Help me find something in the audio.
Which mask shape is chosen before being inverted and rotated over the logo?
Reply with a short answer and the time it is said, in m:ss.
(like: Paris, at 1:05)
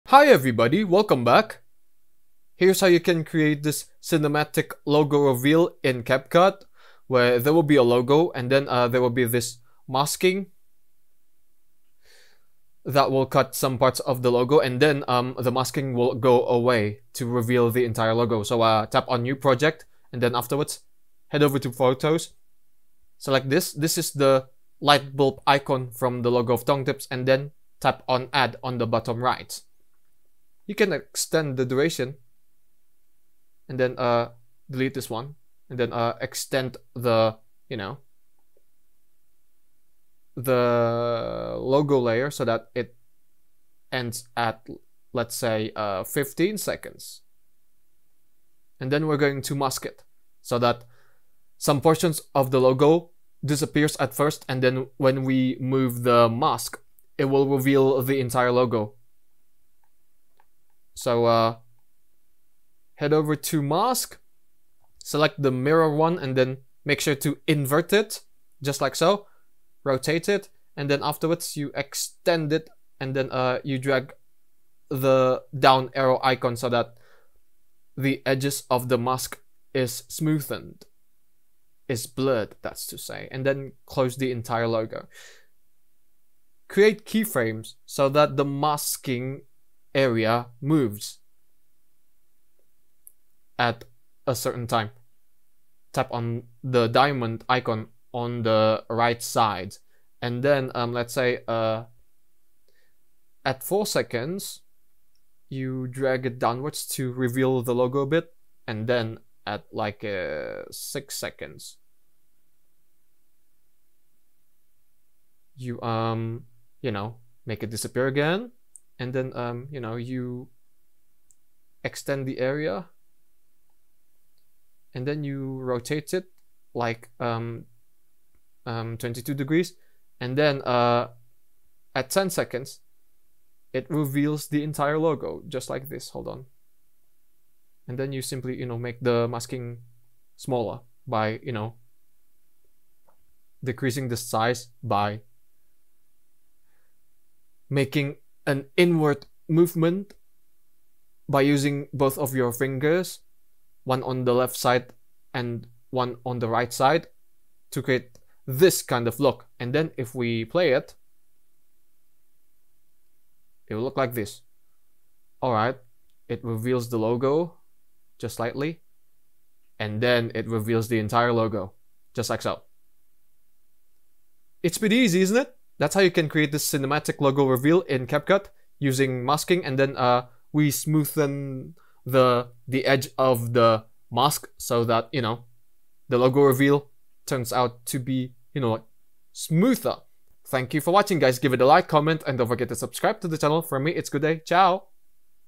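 mirror, at 1:05.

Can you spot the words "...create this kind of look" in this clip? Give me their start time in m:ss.
2:37.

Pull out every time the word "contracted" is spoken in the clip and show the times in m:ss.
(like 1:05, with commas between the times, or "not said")
not said.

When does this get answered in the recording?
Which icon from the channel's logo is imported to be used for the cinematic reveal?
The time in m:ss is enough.
0:24.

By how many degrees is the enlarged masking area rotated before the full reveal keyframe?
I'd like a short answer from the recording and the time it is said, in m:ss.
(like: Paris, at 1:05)
22, at 2:08.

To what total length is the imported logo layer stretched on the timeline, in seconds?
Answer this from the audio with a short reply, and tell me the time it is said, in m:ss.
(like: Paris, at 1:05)
15 seconds, at 0:46.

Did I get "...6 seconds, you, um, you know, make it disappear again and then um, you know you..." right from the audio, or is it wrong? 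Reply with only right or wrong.
right.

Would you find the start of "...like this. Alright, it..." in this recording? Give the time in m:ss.
2:43.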